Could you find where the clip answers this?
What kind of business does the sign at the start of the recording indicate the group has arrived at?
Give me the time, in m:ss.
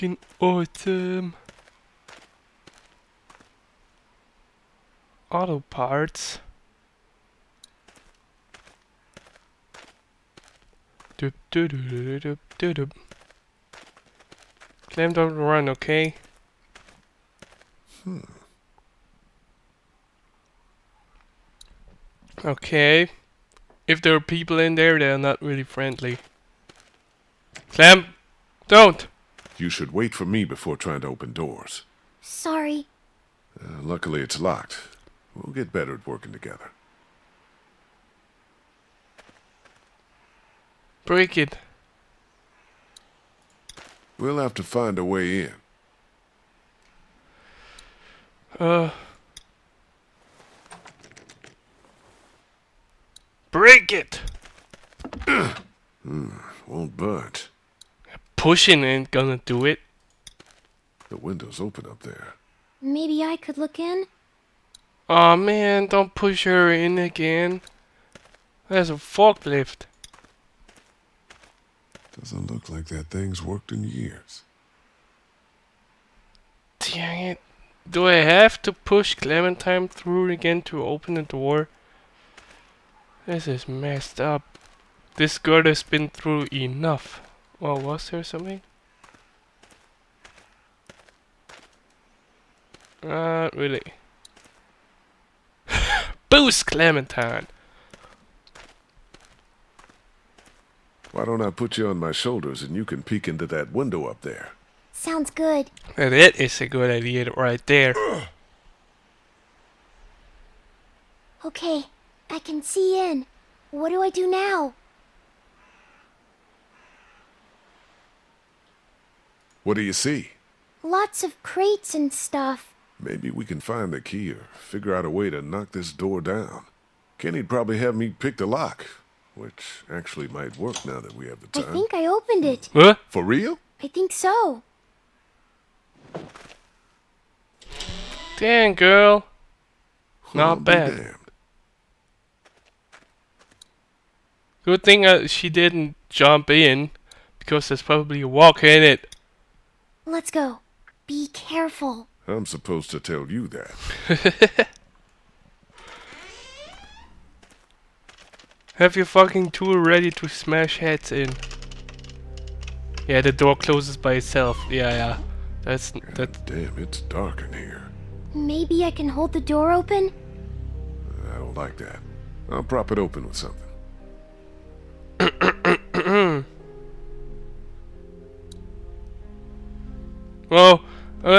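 0:05.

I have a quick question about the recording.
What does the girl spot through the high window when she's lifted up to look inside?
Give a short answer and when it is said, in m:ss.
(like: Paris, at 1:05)
Crates, at 2:01.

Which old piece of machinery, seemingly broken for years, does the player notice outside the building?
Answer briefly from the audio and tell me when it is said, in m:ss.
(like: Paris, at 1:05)
Forklift, at 1:08.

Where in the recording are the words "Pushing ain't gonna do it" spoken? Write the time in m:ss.
0:58.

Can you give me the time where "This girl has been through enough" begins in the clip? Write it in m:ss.
1:25.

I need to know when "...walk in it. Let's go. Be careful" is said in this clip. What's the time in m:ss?
2:28.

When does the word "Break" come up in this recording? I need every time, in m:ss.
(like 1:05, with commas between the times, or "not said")
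0:41, 0:53.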